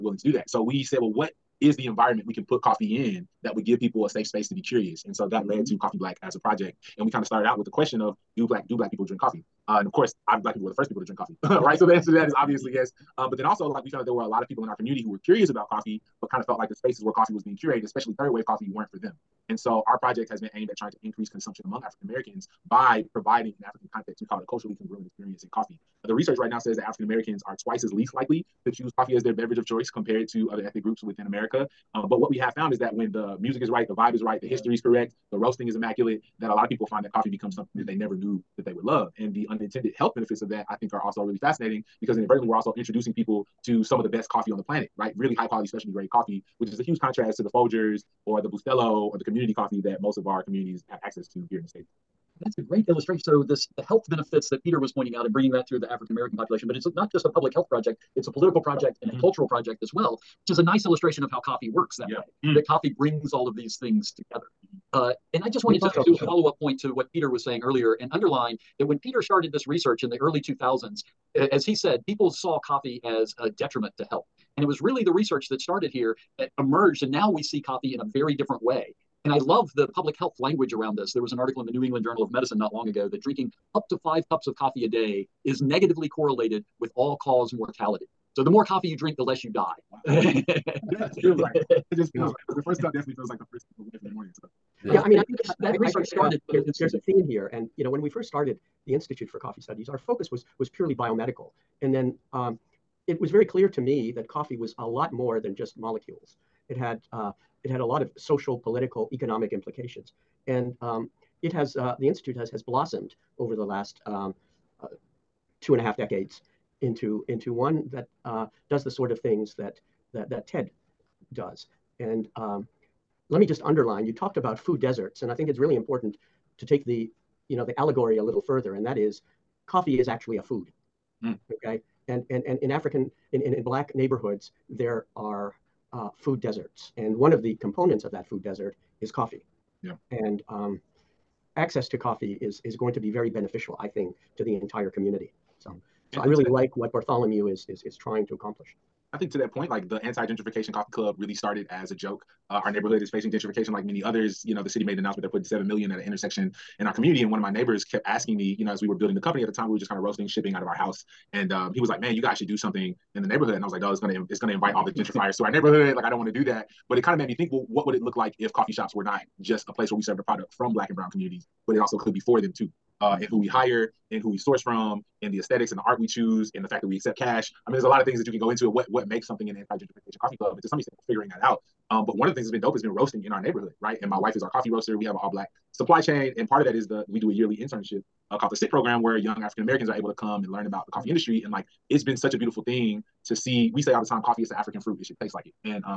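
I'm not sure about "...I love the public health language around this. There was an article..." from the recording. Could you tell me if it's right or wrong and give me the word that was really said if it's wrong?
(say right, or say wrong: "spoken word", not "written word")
right.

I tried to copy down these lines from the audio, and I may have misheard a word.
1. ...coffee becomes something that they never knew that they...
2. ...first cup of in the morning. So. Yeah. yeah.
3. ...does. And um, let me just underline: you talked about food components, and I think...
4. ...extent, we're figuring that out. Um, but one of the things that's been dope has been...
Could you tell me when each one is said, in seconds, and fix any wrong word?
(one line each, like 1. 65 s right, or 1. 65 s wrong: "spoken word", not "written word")
1. 37 s right
2. 93 s right
3. 121 s wrong: "deserts", not "components"
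4. 180 s right.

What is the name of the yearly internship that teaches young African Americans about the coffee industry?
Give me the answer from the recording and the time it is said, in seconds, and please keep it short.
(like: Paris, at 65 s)
SIT program, at 188 s.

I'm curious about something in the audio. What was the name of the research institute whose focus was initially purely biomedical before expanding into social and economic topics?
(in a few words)
Institute for Coffee Studies.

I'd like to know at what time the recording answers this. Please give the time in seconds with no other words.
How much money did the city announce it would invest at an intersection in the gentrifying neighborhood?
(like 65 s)
155 s.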